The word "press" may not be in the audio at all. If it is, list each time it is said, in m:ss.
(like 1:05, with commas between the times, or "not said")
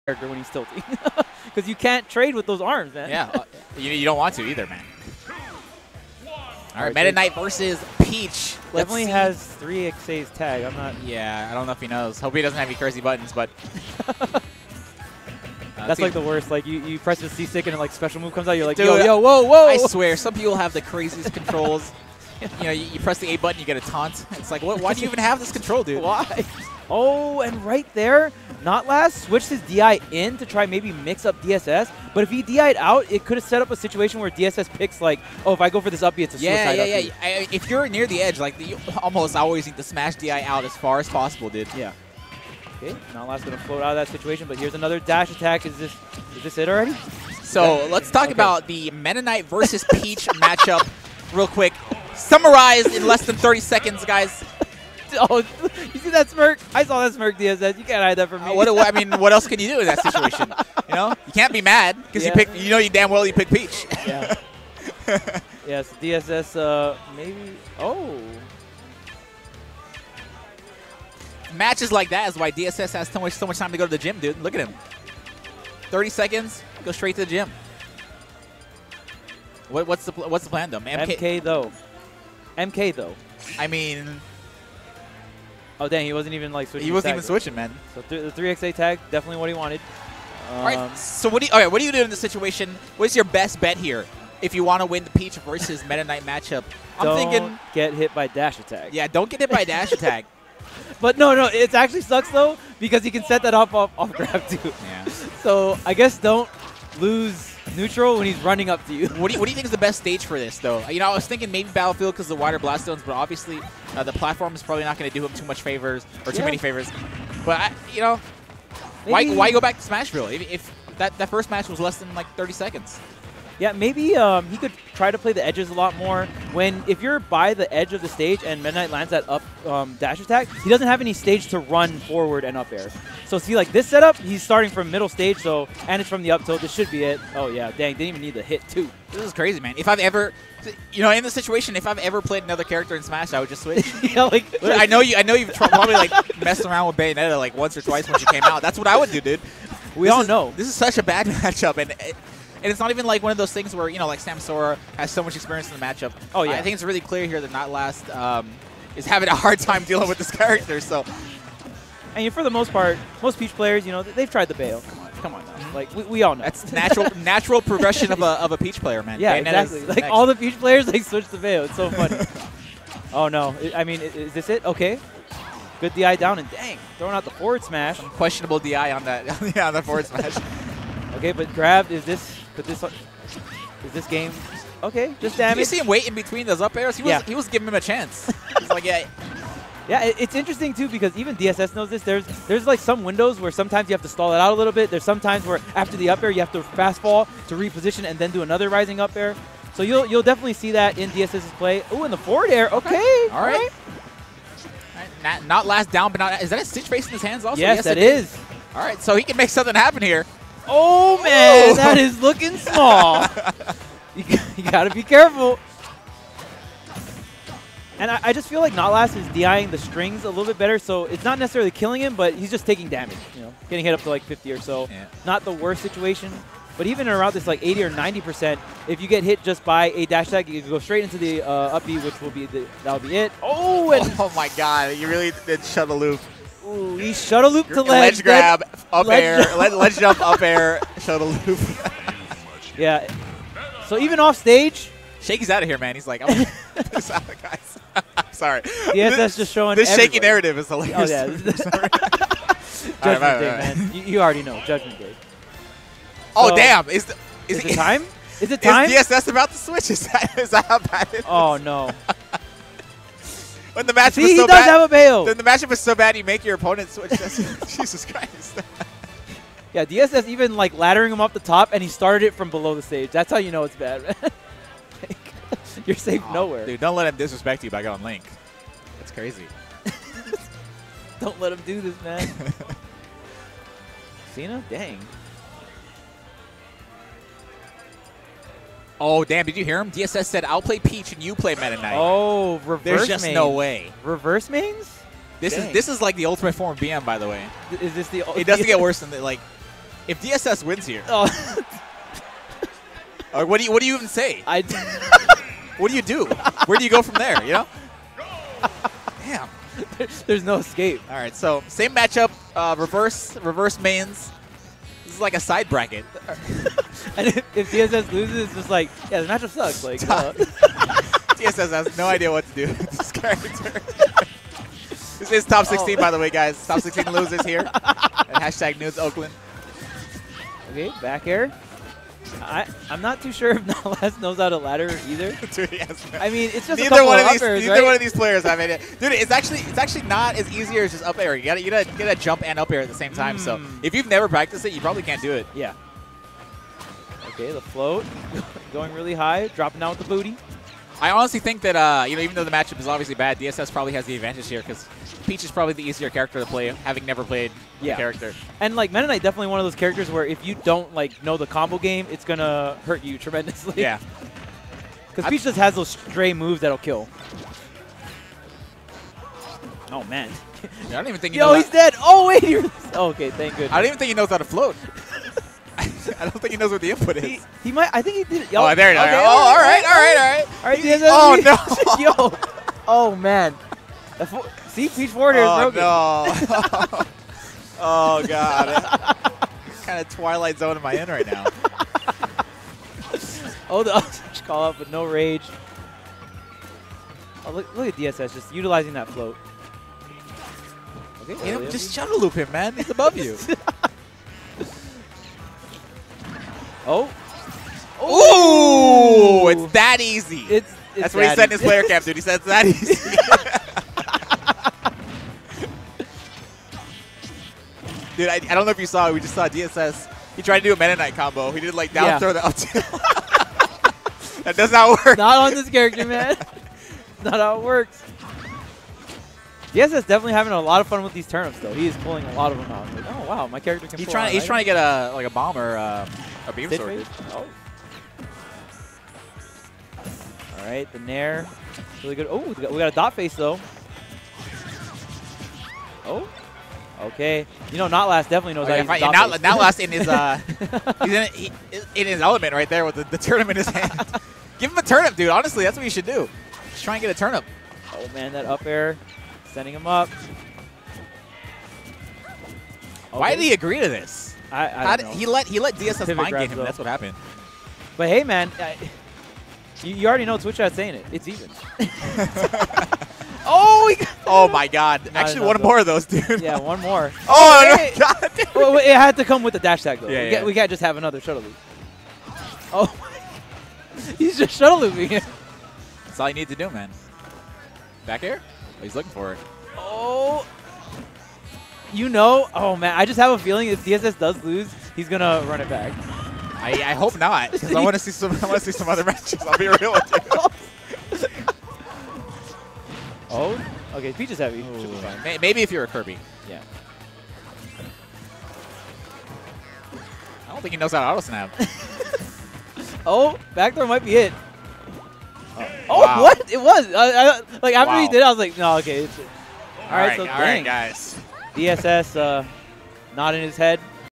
0:16, 0:22.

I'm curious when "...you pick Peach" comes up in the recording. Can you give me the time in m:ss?
1:03.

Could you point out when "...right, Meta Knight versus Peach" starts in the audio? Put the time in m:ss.
0:06.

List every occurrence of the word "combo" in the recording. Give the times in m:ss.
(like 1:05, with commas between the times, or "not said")
6:01, 7:01.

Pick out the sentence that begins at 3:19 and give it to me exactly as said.
So you'll you'll definitely see that in DSS's play.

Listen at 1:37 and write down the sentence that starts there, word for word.
I'm don't thinking get hit by dash attack.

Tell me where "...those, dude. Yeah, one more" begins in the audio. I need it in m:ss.
7:55.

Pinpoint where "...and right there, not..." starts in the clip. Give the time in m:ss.
0:27.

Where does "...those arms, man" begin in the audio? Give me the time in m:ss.
0:02.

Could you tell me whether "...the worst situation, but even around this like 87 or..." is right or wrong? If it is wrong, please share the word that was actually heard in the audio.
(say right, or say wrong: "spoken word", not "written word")
wrong: "80", not "87".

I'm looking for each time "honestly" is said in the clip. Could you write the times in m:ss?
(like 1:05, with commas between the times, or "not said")
5:51, 7:35.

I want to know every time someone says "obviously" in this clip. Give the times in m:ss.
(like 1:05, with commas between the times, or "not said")
1:53, 5:52.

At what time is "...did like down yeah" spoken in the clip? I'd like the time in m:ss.
7:01.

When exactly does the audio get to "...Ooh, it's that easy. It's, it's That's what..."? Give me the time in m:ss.
6:49.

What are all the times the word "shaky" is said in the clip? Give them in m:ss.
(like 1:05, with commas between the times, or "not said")
4:05, 4:10.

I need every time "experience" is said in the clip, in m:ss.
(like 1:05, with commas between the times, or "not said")
2:35.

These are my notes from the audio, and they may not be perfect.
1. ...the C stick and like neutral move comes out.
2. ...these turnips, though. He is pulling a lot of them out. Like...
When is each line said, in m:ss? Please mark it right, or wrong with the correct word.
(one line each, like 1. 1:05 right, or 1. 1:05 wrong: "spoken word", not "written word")
1. 0:17 wrong: "special", not "neutral"
2. 7:11 right.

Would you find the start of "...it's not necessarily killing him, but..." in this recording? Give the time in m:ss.
3:41.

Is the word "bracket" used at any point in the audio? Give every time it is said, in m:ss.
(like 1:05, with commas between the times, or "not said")
5:15.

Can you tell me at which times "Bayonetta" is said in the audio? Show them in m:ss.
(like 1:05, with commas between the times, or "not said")
2:26, 2:49.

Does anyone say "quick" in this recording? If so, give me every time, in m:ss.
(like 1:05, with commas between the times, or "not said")
0:51.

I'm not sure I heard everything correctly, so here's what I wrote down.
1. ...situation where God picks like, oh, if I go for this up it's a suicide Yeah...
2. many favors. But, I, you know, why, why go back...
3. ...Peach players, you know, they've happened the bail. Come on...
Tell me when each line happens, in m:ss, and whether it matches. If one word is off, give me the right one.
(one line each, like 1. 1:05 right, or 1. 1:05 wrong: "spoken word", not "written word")
1. 0:33 wrong: "DSS", not "God"
2. 1:56 right
3. 2:43 wrong: "tried", not "happened".